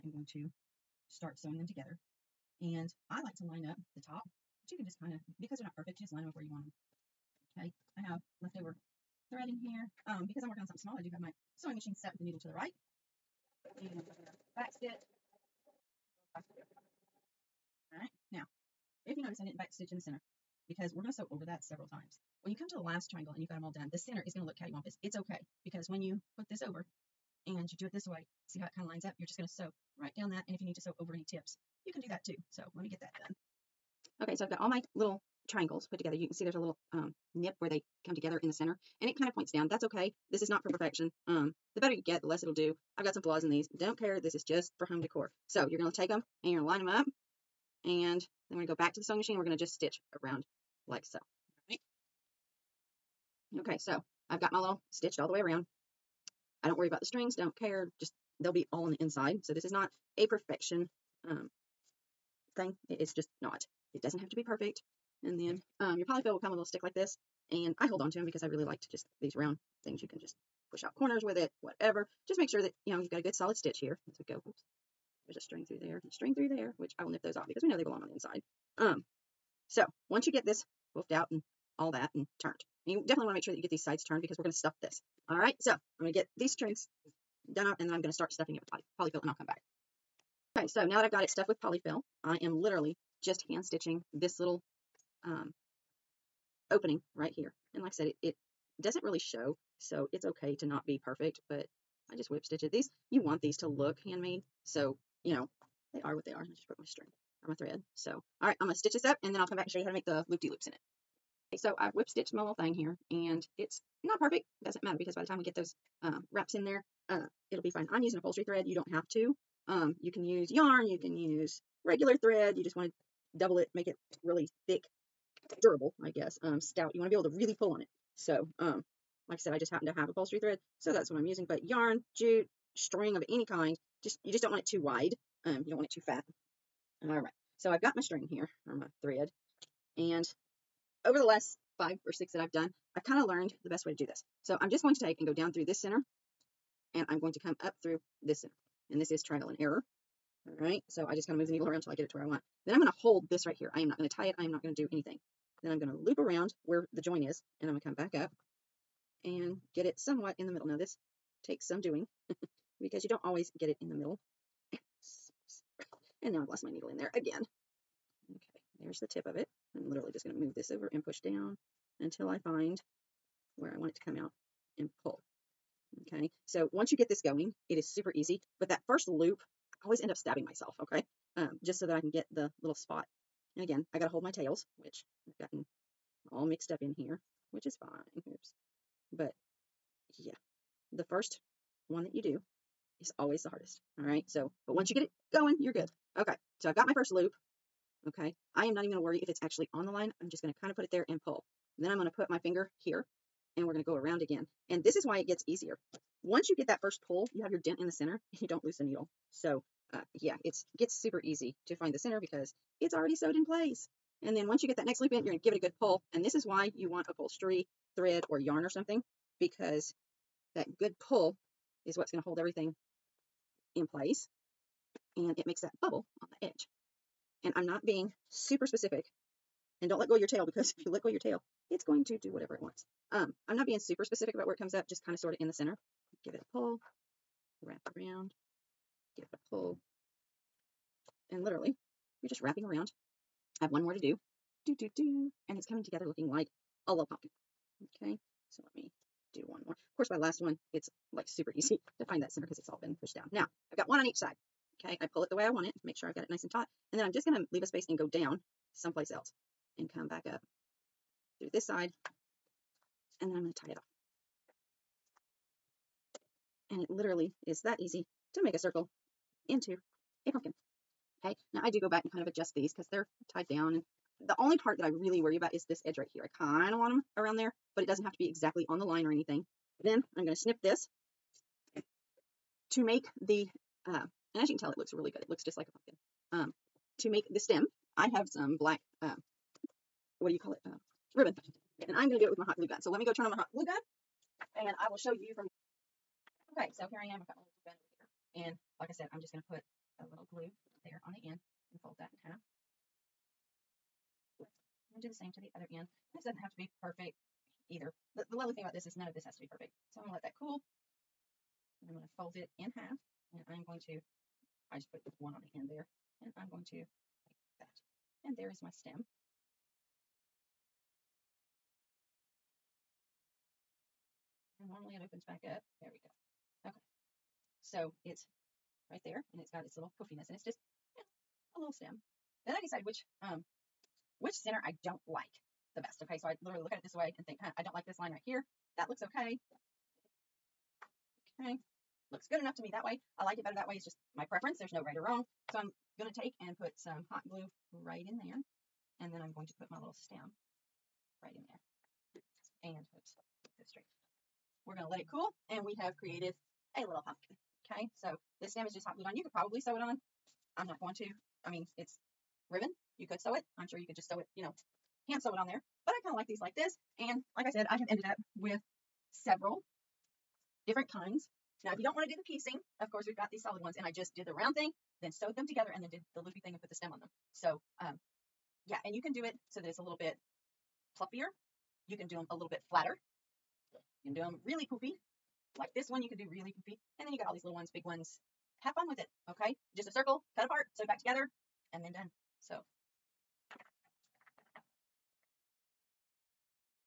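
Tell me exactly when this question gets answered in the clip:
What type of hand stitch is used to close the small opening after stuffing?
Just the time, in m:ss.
1:42.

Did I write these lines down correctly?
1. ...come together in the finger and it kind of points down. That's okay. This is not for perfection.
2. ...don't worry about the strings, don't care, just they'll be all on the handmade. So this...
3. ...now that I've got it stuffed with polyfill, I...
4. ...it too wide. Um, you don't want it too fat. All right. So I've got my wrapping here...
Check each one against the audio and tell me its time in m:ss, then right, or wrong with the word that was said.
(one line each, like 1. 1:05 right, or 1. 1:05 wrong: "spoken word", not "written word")
1. 0:38 wrong: "center", not "finger"
2. 0:56 wrong: "inside", not "handmade"
3. 1:30 right
4. 2:14 wrong: "string", not "wrapping".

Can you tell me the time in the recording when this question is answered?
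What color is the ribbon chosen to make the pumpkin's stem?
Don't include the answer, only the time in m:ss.
4:48.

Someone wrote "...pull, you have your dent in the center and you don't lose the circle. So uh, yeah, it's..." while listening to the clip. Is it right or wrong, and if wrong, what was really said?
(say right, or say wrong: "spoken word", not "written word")
wrong: "needle", not "circle".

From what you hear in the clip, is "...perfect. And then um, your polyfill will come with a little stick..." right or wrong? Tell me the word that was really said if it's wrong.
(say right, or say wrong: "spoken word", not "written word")
right.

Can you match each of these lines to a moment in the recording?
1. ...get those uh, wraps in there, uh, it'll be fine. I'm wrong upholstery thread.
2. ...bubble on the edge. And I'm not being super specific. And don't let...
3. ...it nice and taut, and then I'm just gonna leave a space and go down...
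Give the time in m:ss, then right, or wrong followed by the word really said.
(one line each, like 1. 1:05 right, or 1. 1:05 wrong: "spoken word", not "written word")
1. 1:55 wrong: "using", not "wrong"
2. 3:45 right
3. 4:16 right.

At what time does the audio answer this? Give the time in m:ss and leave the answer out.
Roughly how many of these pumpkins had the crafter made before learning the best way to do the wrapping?
2:21.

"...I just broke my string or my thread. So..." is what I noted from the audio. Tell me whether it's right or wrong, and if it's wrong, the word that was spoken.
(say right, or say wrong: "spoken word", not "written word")
right.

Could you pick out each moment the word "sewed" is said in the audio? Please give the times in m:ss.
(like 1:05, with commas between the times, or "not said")
3:33, 6:15, 6:30.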